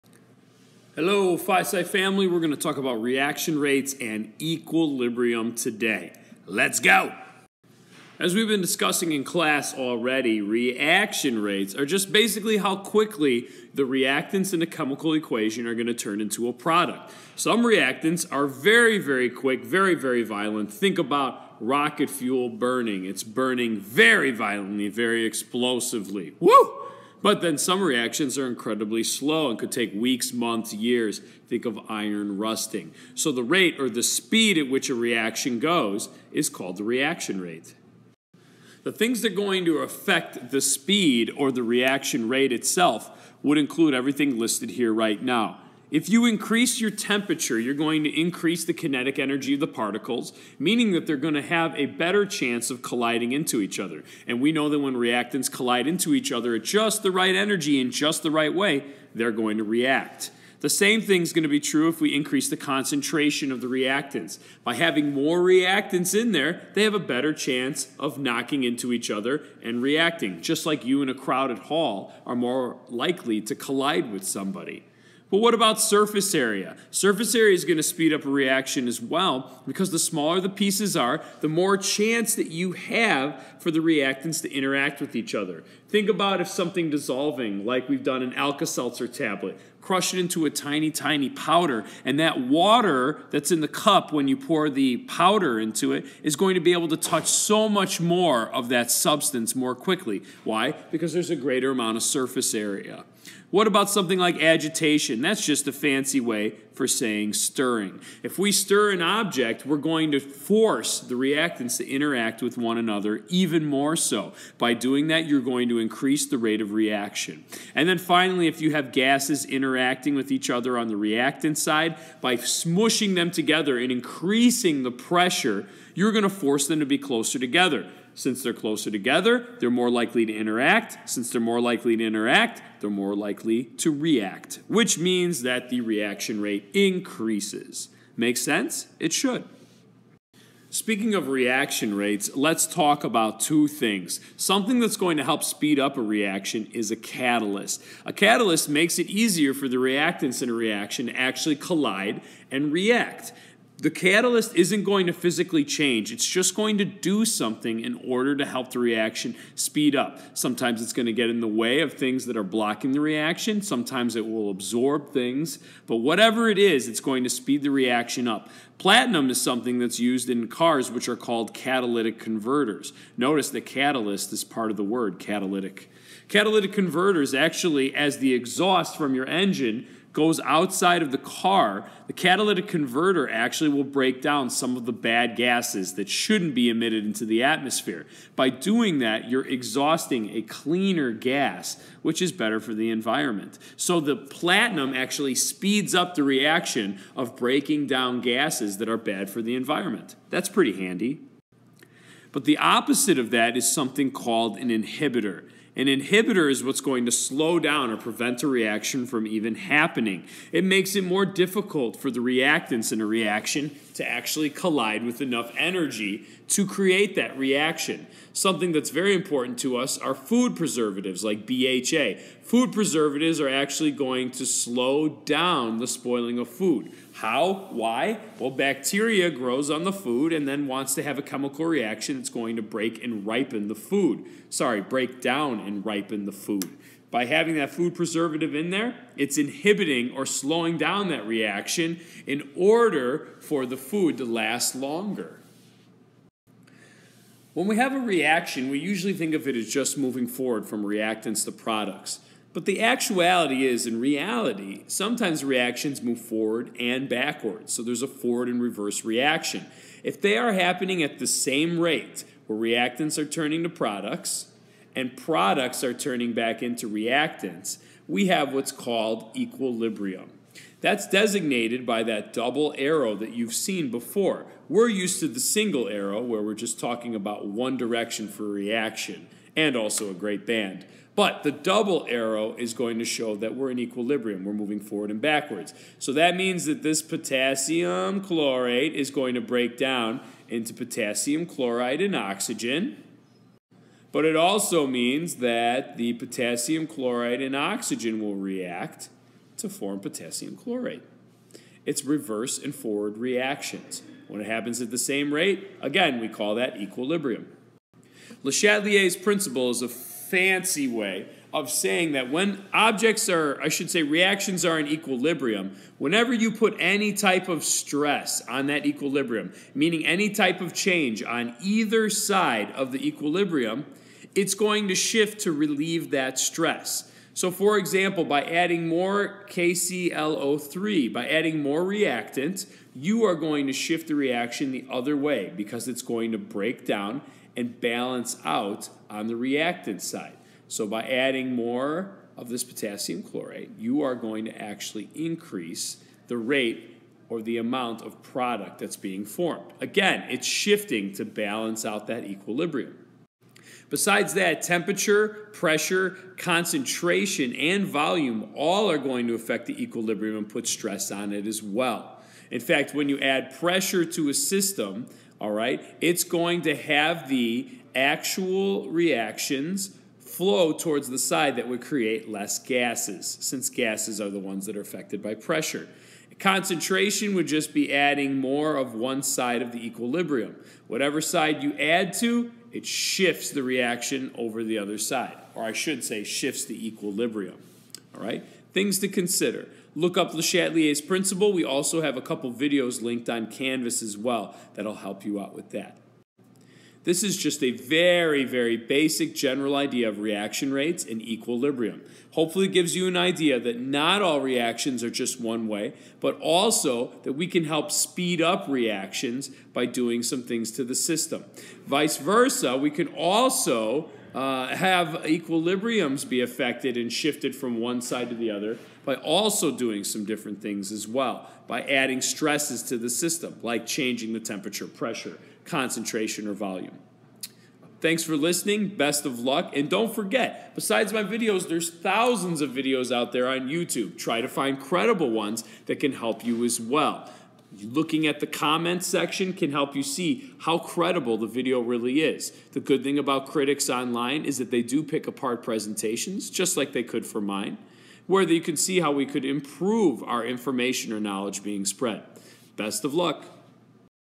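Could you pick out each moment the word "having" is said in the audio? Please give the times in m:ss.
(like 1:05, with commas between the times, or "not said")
1:04, 3:57.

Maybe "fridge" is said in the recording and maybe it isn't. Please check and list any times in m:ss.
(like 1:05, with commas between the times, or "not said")
not said.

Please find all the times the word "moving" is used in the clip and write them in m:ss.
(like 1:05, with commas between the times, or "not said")
4:09, 4:44.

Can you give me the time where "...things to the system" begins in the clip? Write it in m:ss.
6:50.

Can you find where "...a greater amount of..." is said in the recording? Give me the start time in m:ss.
1:41.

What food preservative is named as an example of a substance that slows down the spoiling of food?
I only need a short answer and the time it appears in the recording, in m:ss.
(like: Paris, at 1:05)
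BHA, at 3:41.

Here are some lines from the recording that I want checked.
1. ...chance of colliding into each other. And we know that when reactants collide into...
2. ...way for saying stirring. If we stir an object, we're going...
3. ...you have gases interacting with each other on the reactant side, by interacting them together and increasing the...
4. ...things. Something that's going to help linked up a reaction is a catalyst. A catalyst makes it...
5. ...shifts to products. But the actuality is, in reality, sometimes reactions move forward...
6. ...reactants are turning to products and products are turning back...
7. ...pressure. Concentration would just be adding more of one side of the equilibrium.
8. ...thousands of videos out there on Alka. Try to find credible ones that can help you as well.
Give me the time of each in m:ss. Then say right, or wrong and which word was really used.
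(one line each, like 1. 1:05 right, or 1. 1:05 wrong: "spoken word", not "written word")
1. 0:52 right
2. 1:46 right
3. 1:58 wrong: "smushing", not "interacting"
4. 2:23 wrong: "speed", not "linked"
5. 4:10 wrong: "reactants", not "shifts"
6. 4:22 right
7. 6:15 right
8. 7:11 wrong: "YouTube", not "Alka".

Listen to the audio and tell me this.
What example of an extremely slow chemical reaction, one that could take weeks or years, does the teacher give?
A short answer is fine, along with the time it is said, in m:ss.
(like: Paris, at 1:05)
iron rusting, at 0:31.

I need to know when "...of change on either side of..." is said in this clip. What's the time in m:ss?
5:20.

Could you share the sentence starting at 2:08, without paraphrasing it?
Since they're closer together, they're more likely to interact.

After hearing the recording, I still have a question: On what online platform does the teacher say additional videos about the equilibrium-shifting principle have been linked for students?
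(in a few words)
Canvas.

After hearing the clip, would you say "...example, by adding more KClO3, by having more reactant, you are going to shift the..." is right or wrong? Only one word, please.
wrong.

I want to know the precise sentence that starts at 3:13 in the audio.
So the platinum actually speeds up the reaction of breaking down gases that are bad for the environment.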